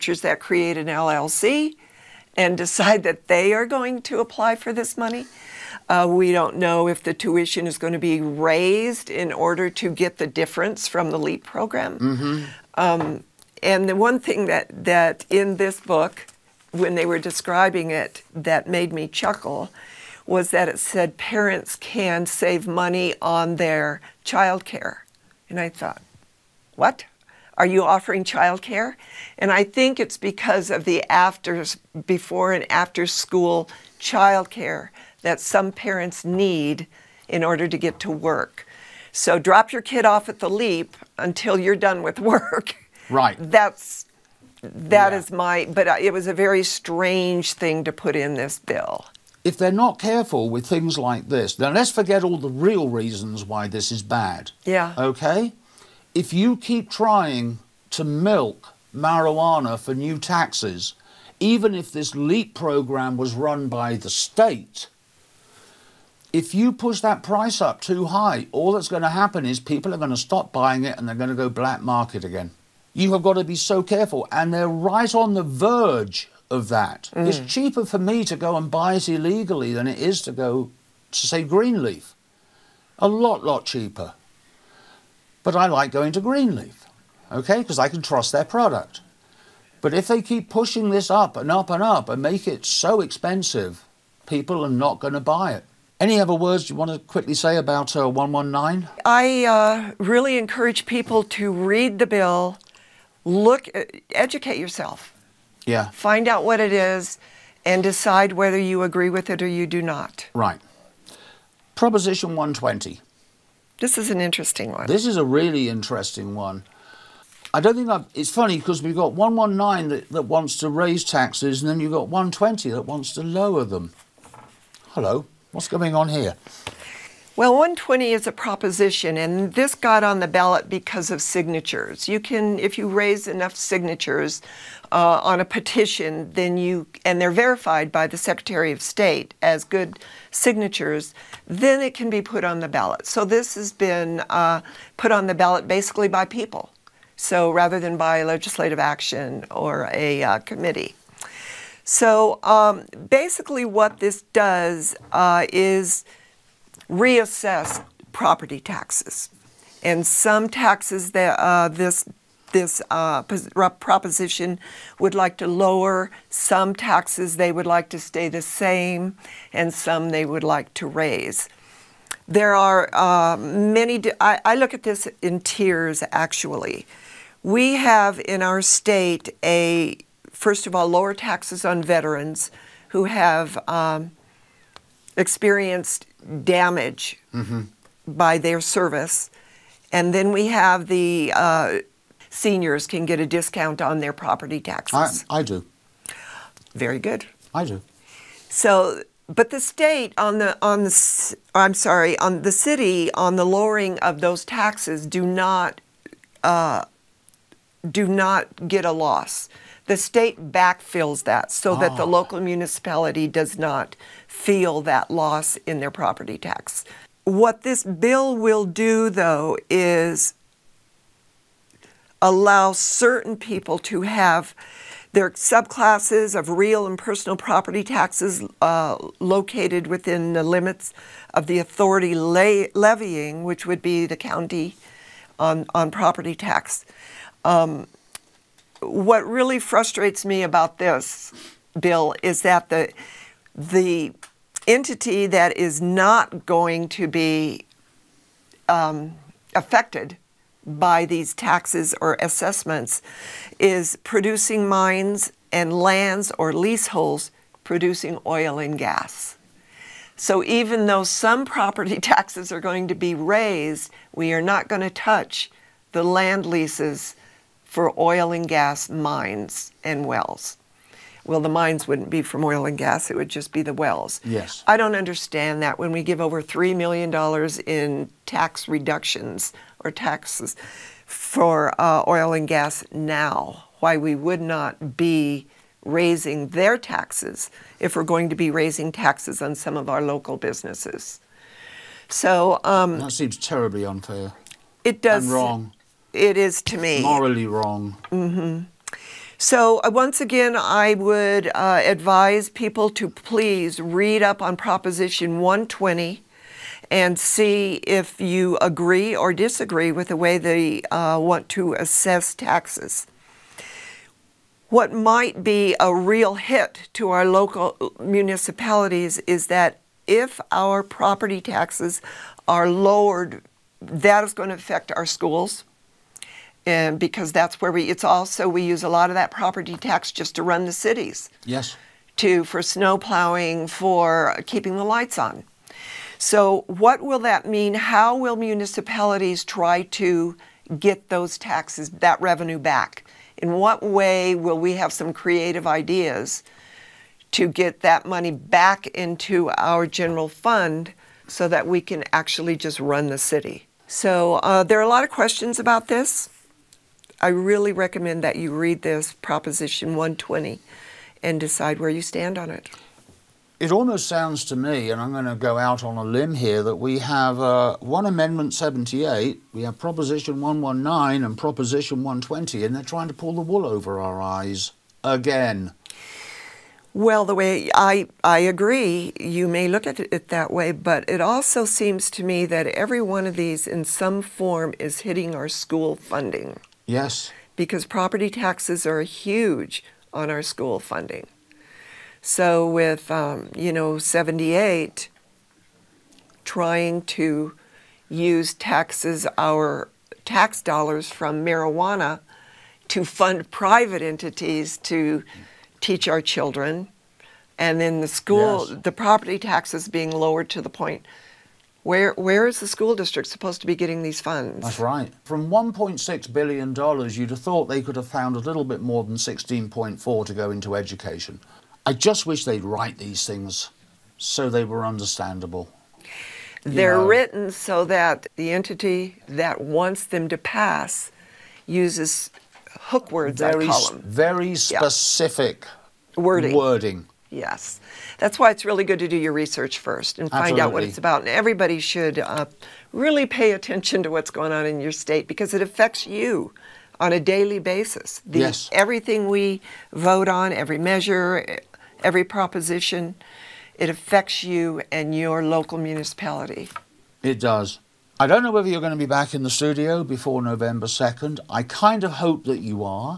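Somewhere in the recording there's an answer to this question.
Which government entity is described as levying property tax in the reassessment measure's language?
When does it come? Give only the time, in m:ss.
3:54.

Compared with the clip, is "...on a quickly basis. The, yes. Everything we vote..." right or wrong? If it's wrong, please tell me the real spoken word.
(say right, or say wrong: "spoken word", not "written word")
wrong: "daily", not "quickly".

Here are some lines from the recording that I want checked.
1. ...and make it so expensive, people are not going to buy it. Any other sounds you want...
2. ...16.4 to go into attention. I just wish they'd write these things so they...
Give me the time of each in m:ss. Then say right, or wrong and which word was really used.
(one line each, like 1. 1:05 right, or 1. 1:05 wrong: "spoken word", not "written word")
1. 1:32 wrong: "words", not "sounds"
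2. 6:59 wrong: "education", not "attention".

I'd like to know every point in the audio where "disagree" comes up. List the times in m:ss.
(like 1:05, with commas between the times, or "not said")
5:09.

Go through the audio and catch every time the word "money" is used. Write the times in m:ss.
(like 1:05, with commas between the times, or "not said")
0:04, 0:22, 5:48.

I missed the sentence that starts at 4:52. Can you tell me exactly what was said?
So um, that seems terribly unfair.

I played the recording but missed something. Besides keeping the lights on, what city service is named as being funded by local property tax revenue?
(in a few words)
Snow plowing.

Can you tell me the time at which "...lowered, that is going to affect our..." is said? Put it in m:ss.
5:22.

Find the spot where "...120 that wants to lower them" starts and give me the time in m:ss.
2:02.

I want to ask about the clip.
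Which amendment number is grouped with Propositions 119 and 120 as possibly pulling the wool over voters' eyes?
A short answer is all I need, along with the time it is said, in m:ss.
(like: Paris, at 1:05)
78, at 6:08.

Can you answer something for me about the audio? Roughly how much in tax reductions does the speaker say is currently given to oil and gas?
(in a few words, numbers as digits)
Over $3 million.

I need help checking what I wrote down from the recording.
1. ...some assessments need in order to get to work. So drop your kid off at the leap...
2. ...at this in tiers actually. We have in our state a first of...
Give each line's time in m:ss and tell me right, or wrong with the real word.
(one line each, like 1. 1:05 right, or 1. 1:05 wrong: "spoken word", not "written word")
1. 0:35 wrong: "parents", not "assessments"
2. 2:54 right.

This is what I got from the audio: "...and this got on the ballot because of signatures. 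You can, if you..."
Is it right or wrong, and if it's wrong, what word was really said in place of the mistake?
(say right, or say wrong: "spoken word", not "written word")
right.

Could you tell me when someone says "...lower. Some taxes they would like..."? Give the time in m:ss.
2:45.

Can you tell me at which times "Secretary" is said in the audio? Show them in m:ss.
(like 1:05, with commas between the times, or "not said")
2:18.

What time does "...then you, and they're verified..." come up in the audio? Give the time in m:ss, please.
2:16.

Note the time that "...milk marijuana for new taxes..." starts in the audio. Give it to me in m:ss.
0:58.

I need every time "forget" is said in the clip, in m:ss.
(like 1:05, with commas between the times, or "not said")
0:51.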